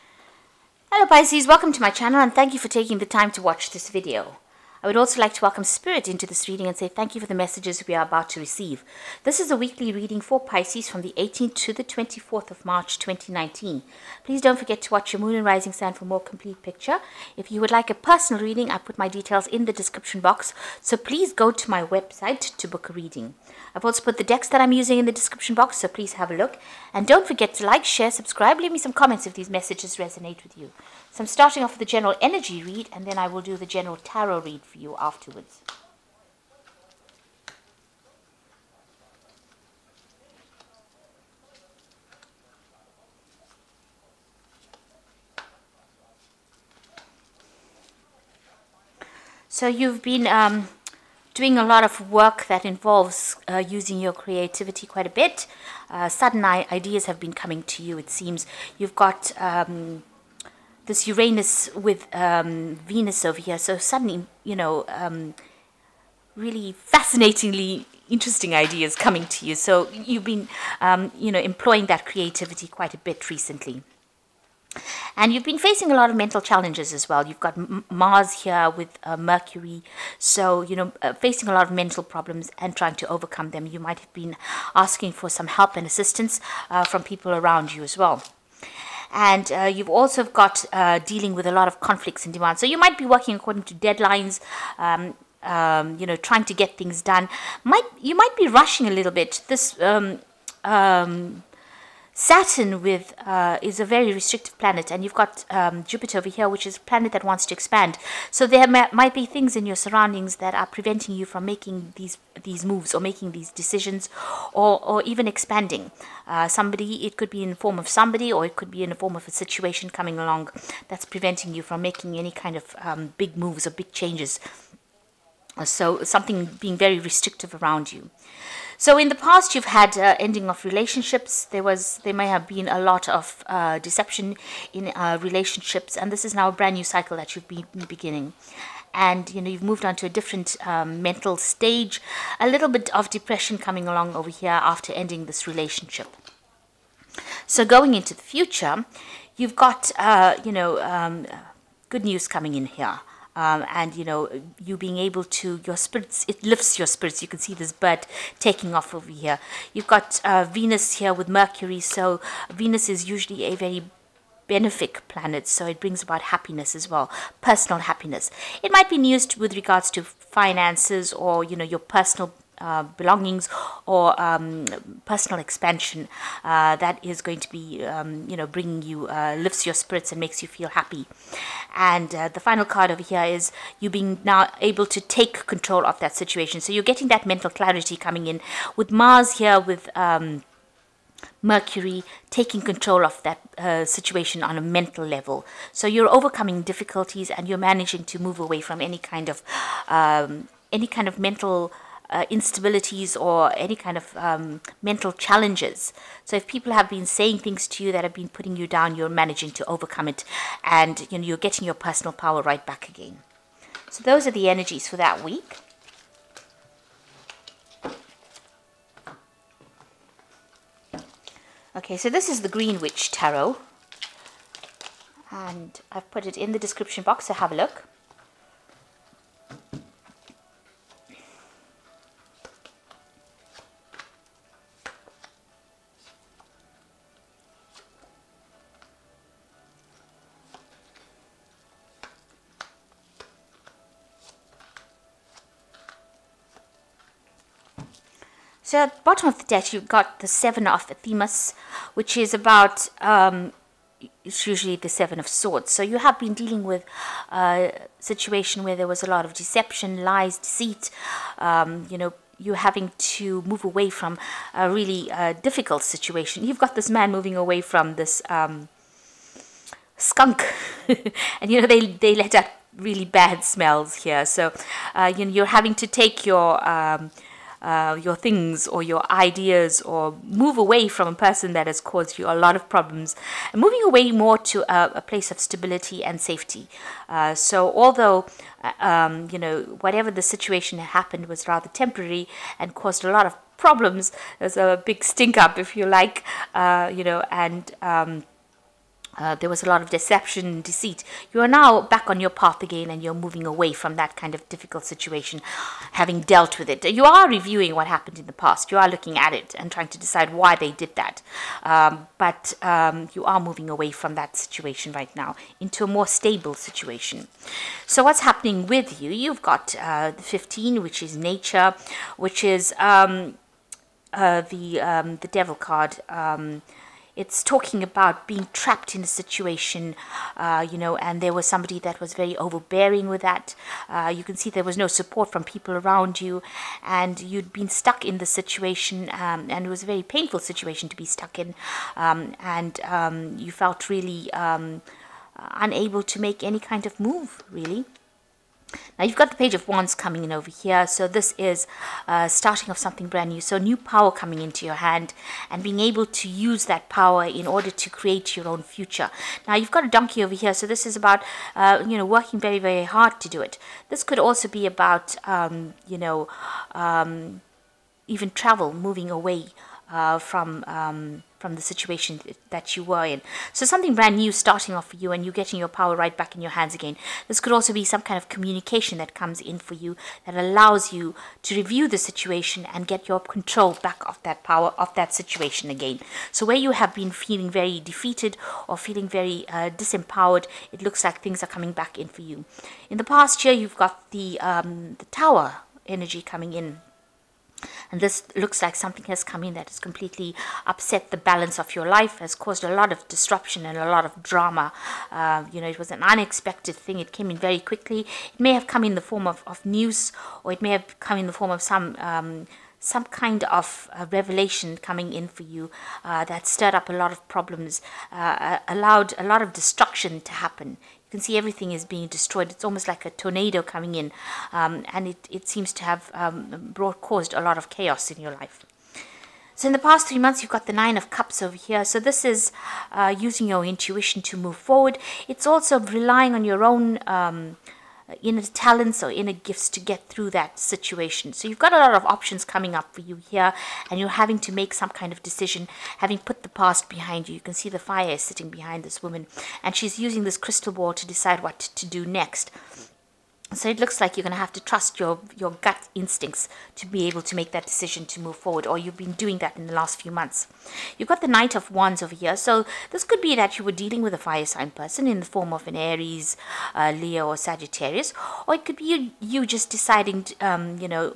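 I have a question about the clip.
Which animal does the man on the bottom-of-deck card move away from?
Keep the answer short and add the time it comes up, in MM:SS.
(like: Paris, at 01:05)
skunk, at 04:29.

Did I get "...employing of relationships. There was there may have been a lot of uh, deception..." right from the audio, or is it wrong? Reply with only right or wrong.
wrong.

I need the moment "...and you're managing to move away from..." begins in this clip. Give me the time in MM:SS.
03:17.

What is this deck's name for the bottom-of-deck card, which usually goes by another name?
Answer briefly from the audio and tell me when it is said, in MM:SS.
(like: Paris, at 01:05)
Seven of Athames, at 04:10.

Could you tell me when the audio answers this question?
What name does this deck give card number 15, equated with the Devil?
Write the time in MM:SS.
05:21.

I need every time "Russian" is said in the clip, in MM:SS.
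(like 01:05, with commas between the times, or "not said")
not said.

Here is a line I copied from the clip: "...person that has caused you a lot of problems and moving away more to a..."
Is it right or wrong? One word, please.
right.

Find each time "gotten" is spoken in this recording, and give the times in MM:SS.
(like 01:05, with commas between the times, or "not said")
not said.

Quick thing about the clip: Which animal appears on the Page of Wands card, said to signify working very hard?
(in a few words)
donkey.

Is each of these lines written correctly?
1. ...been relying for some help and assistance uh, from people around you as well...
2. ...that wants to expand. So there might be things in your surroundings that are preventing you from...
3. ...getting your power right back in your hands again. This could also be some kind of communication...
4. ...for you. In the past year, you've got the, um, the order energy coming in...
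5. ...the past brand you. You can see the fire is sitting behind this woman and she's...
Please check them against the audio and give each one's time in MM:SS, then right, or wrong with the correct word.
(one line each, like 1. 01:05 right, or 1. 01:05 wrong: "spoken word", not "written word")
1. 01:24 wrong: "asking", not "relying"
2. 01:47 right
3. 06:15 right
4. 06:32 wrong: "tower", not "order"
5. 07:26 wrong: "behind", not "brand".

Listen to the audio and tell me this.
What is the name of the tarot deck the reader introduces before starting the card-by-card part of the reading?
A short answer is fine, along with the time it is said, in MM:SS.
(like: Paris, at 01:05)
Green Witch Tarot, at 03:42.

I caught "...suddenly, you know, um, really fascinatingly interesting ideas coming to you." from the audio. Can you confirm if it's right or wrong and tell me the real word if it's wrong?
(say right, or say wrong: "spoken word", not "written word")
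right.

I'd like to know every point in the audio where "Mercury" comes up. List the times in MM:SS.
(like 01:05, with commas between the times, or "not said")
01:19, 02:41, 03:11.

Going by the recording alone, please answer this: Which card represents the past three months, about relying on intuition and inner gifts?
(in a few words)
Nine of Cups.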